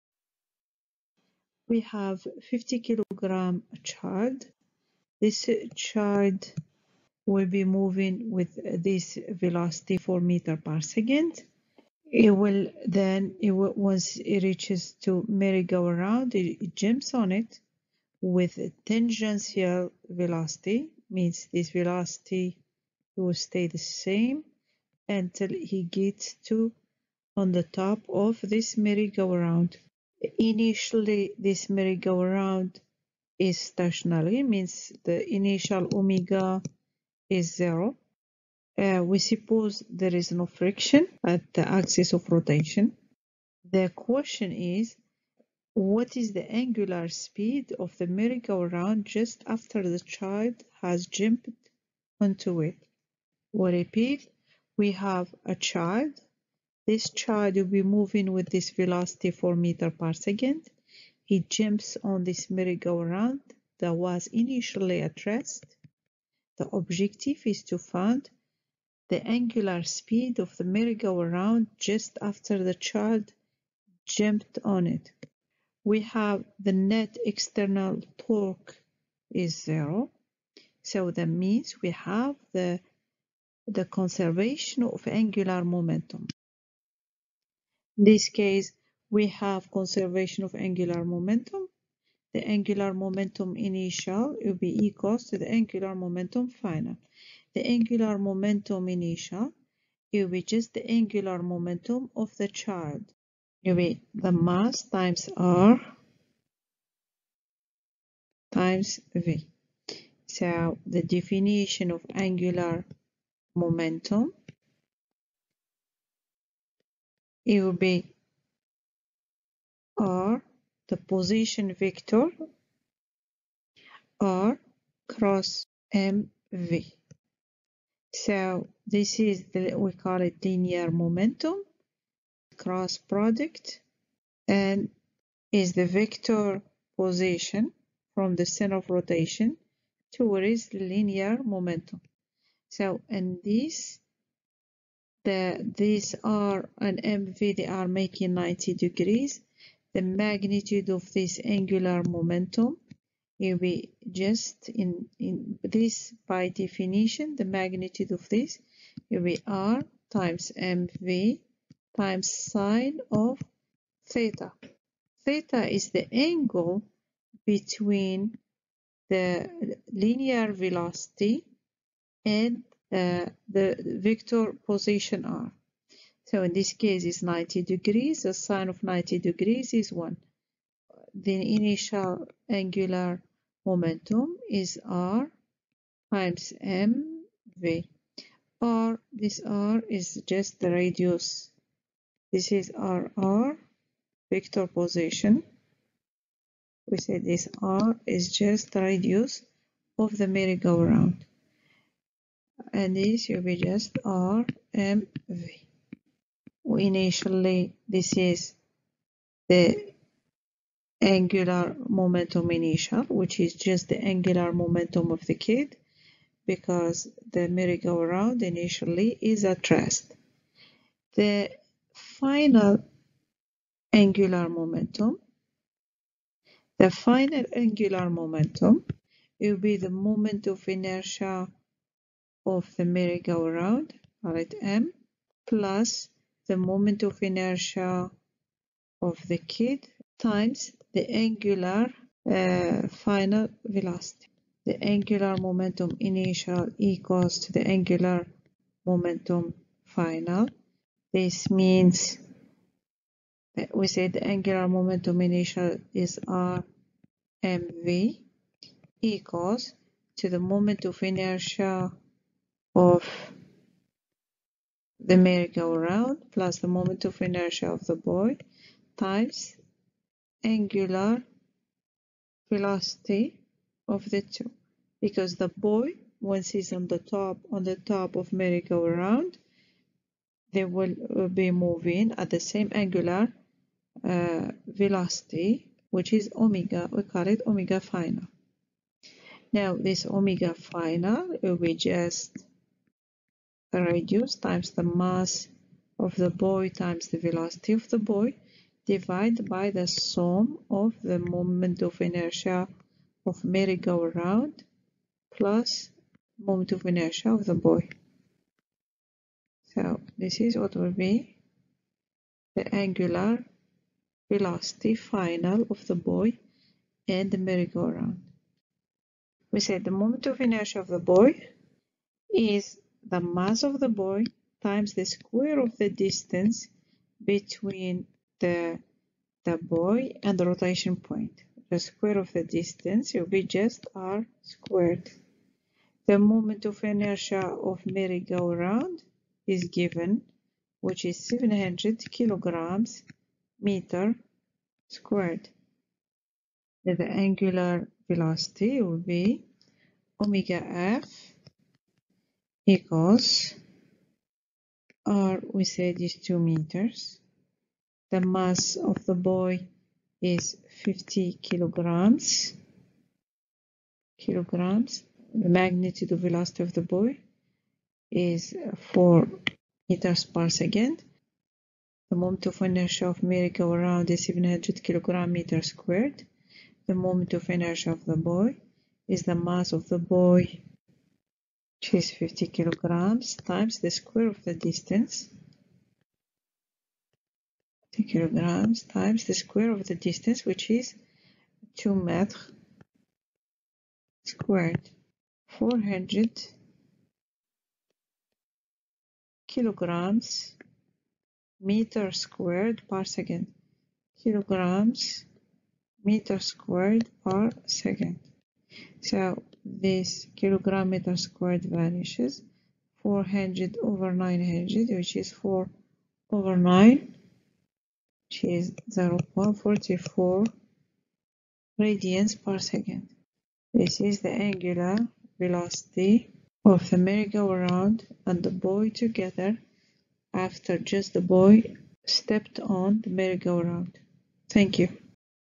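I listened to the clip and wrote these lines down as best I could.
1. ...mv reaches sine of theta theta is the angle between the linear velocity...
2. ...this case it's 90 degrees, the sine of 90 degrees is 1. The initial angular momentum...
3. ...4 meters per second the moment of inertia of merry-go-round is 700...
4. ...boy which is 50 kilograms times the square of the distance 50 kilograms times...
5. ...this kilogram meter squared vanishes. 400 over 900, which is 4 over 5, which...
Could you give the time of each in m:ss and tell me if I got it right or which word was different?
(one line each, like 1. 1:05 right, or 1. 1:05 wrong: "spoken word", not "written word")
1. 2:40 wrong: "times", not "reaches"
2. 2:56 right
3. 6:08 right
4. 6:19 right
5. 6:49 wrong: "9", not "5".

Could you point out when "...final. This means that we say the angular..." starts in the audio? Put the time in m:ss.
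4:09.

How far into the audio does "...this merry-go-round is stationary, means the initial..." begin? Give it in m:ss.
0:31.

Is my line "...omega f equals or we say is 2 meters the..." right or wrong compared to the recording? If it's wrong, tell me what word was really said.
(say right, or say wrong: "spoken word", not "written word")
right.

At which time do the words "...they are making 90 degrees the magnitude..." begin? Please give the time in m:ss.
2:27.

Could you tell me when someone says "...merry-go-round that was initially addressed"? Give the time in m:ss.
1:02.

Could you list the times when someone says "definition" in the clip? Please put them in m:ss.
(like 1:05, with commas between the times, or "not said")
1:51, 2:36.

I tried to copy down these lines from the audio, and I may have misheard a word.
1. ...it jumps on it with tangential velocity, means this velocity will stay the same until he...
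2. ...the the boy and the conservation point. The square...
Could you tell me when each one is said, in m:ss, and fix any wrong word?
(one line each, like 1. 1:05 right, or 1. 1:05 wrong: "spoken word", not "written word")
1. 0:16 right
2. 5:28 wrong: "rotation", not "conservation".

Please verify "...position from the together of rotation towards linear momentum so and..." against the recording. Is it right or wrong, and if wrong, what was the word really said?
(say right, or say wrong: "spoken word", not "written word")
wrong: "center", not "together".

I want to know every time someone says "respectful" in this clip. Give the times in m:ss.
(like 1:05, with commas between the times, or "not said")
not said.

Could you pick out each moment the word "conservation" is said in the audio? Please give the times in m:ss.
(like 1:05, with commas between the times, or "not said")
1:23, 1:29.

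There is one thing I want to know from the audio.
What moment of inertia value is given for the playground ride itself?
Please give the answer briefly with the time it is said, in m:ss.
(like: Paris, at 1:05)
700 kg·m², at 5:41.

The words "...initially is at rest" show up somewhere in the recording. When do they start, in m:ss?
3:38.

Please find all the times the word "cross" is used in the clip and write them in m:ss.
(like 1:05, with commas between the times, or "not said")
2:05, 2:12.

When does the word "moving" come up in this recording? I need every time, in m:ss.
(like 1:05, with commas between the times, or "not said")
0:07, 0:57, 4:41.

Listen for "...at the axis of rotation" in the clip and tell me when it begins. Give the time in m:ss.
0:41.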